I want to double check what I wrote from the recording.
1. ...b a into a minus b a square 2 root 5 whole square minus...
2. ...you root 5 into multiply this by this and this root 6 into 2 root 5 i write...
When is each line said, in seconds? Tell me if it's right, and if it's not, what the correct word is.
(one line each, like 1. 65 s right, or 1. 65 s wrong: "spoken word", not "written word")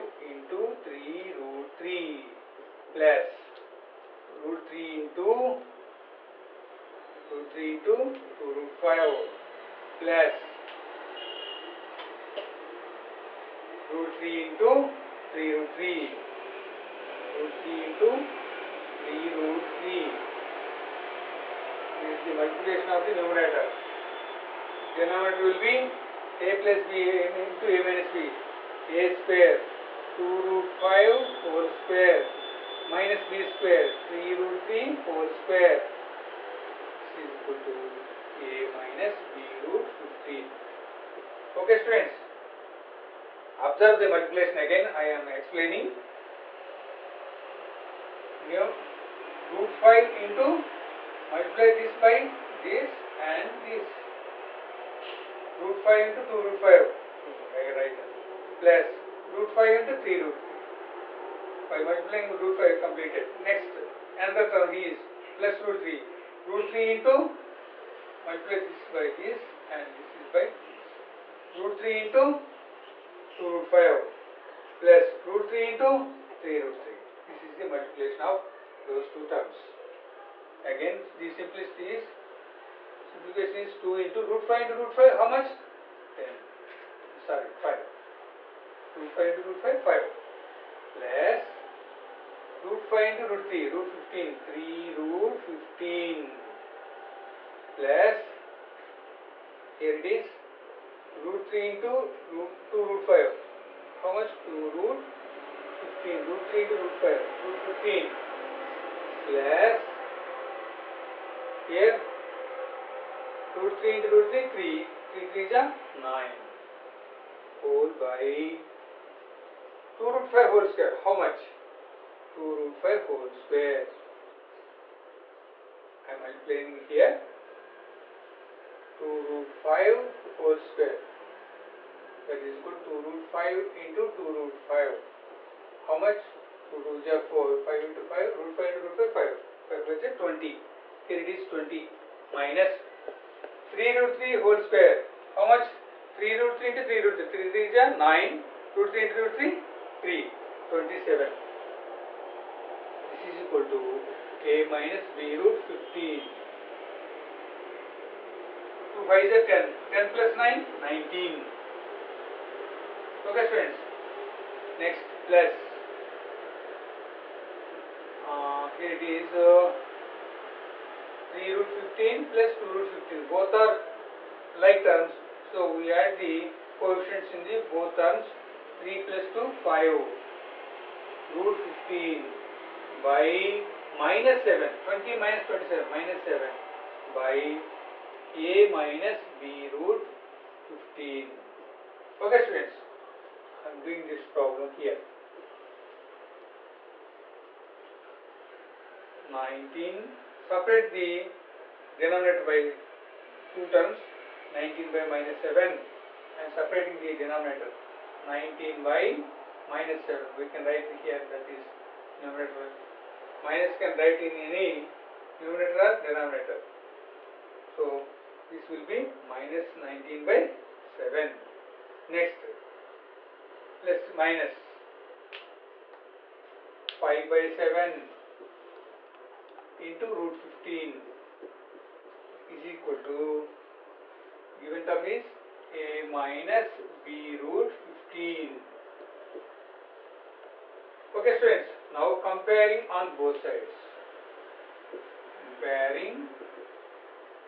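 1. 26 s right
2. 48 s wrong: "5", not "6".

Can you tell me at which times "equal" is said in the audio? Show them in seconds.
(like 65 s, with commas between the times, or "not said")
37 s, 132 s, 153 s, 232 s.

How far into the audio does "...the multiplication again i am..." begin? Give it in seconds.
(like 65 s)
44 s.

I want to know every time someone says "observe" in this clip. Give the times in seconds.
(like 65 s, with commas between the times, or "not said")
43 s.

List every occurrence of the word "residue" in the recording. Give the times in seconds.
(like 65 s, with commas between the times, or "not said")
not said.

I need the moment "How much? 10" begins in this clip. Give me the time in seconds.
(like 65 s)
85 s.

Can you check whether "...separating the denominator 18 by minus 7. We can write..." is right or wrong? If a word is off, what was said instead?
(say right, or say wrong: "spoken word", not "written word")
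wrong: "19", not "18".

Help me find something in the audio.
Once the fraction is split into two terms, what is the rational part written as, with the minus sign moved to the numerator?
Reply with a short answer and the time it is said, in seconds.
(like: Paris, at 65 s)
-19/7, at 219 s.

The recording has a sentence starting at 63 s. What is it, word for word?
Next, another term is plus root 3.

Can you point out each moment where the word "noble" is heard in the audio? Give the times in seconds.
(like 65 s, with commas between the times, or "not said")
not said.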